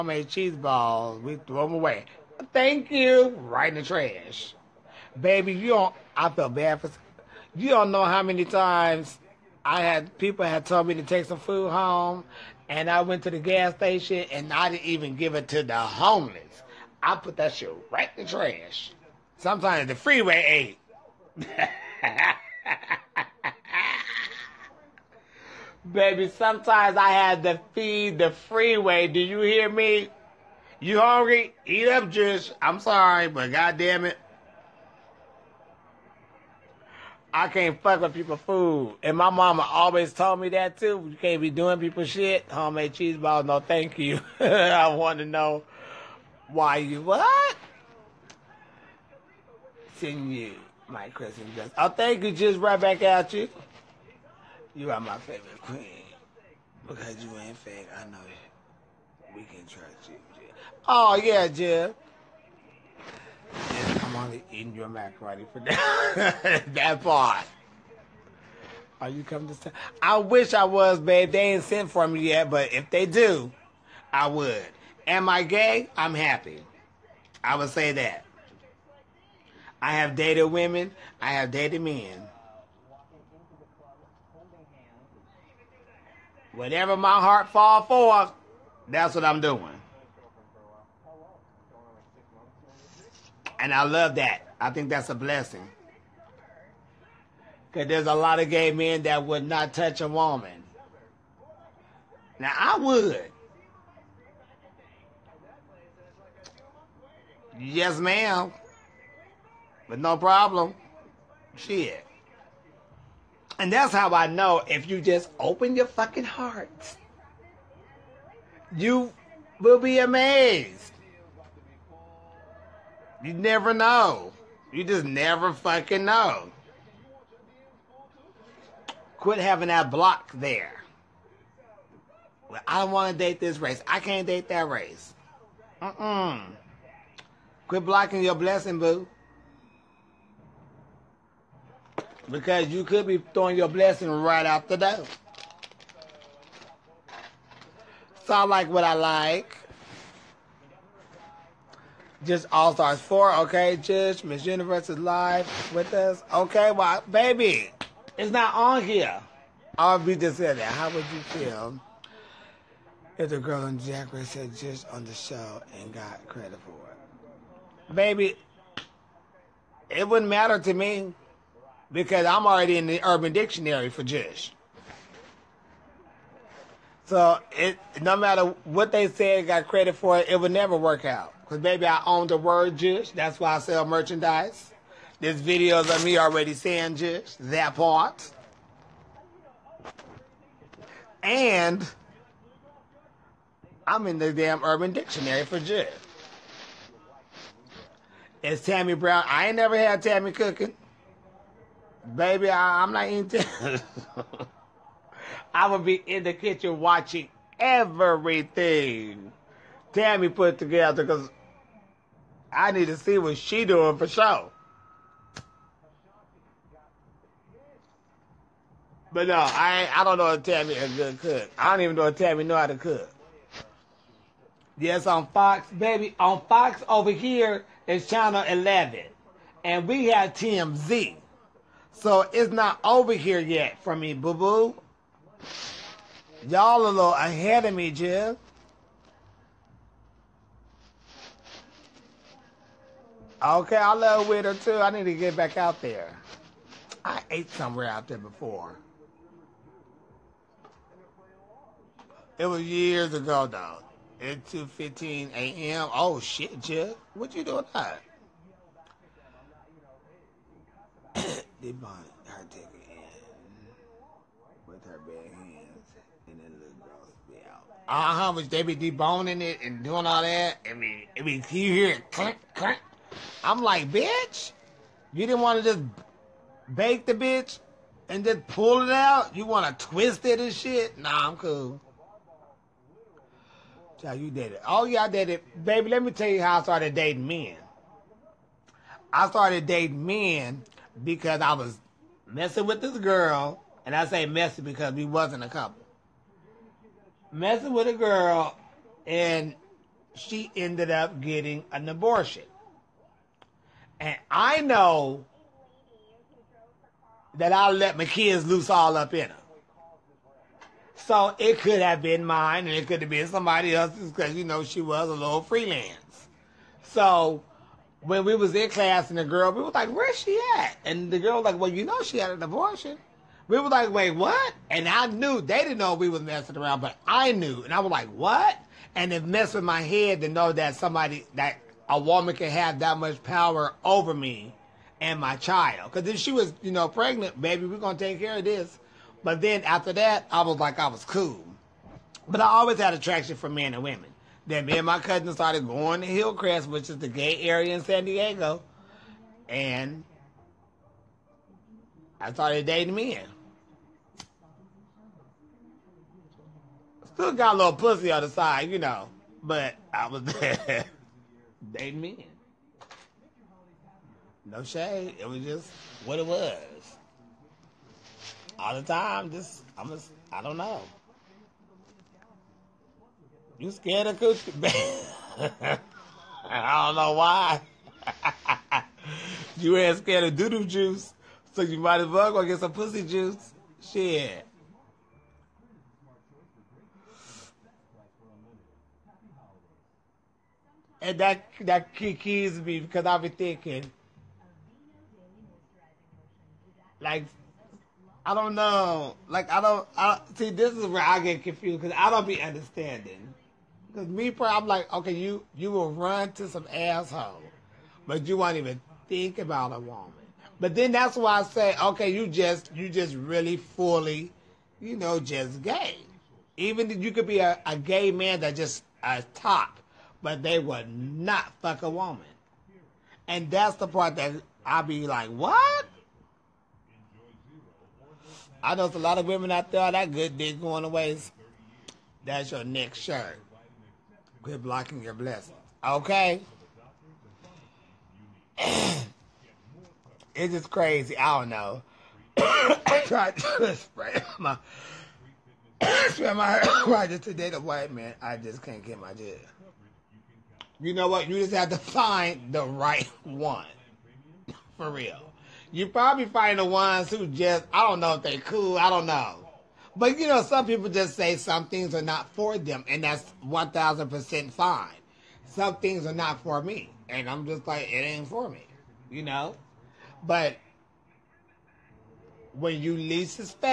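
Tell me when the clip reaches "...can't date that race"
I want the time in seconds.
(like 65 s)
134 s.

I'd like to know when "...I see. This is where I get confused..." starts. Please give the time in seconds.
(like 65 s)
399 s.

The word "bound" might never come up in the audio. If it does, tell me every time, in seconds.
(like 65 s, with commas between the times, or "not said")
261 s.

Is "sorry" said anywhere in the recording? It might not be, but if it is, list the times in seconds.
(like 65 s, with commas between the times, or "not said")
32 s.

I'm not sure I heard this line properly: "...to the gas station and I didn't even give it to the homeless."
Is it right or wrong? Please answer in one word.
right.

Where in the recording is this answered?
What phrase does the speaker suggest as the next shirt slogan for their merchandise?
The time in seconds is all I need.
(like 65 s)
434 s.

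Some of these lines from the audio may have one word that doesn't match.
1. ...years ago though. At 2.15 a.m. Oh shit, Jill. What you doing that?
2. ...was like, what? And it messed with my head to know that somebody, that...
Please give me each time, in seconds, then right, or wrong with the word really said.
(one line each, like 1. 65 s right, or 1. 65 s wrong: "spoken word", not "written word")
1. 252 s right
2. 327 s right.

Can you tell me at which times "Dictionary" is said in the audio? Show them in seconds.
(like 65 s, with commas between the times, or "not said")
173 s, 194 s.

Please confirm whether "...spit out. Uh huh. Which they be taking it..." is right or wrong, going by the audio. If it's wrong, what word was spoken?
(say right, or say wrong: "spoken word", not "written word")
wrong: "deboning", not "taking".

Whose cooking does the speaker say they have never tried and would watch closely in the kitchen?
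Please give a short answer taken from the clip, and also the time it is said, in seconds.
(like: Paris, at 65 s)
Tammy Brown, at 198 s.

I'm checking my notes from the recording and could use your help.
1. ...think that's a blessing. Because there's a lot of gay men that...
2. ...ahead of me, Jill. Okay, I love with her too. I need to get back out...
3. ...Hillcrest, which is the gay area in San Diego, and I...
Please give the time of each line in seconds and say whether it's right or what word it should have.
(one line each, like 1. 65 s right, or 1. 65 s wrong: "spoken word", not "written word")
1. 94 s right
2. 237 s right
3. 346 s right.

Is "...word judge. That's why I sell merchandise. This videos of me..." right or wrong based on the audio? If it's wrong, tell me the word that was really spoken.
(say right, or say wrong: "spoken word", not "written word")
right.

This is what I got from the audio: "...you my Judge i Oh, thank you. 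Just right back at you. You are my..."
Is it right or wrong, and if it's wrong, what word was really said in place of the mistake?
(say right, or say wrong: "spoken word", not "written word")
wrong: "Christmas", not "Judge".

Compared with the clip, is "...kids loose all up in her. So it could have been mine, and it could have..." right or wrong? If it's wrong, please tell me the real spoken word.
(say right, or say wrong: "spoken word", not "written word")
right.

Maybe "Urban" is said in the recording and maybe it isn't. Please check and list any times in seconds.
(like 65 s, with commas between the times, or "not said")
173 s, 194 s.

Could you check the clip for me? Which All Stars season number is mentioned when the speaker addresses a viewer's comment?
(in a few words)
4.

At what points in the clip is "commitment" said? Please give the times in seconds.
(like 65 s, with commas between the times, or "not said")
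not said.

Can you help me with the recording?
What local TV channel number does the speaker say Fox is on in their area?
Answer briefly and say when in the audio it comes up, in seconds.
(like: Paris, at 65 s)
11, at 228 s.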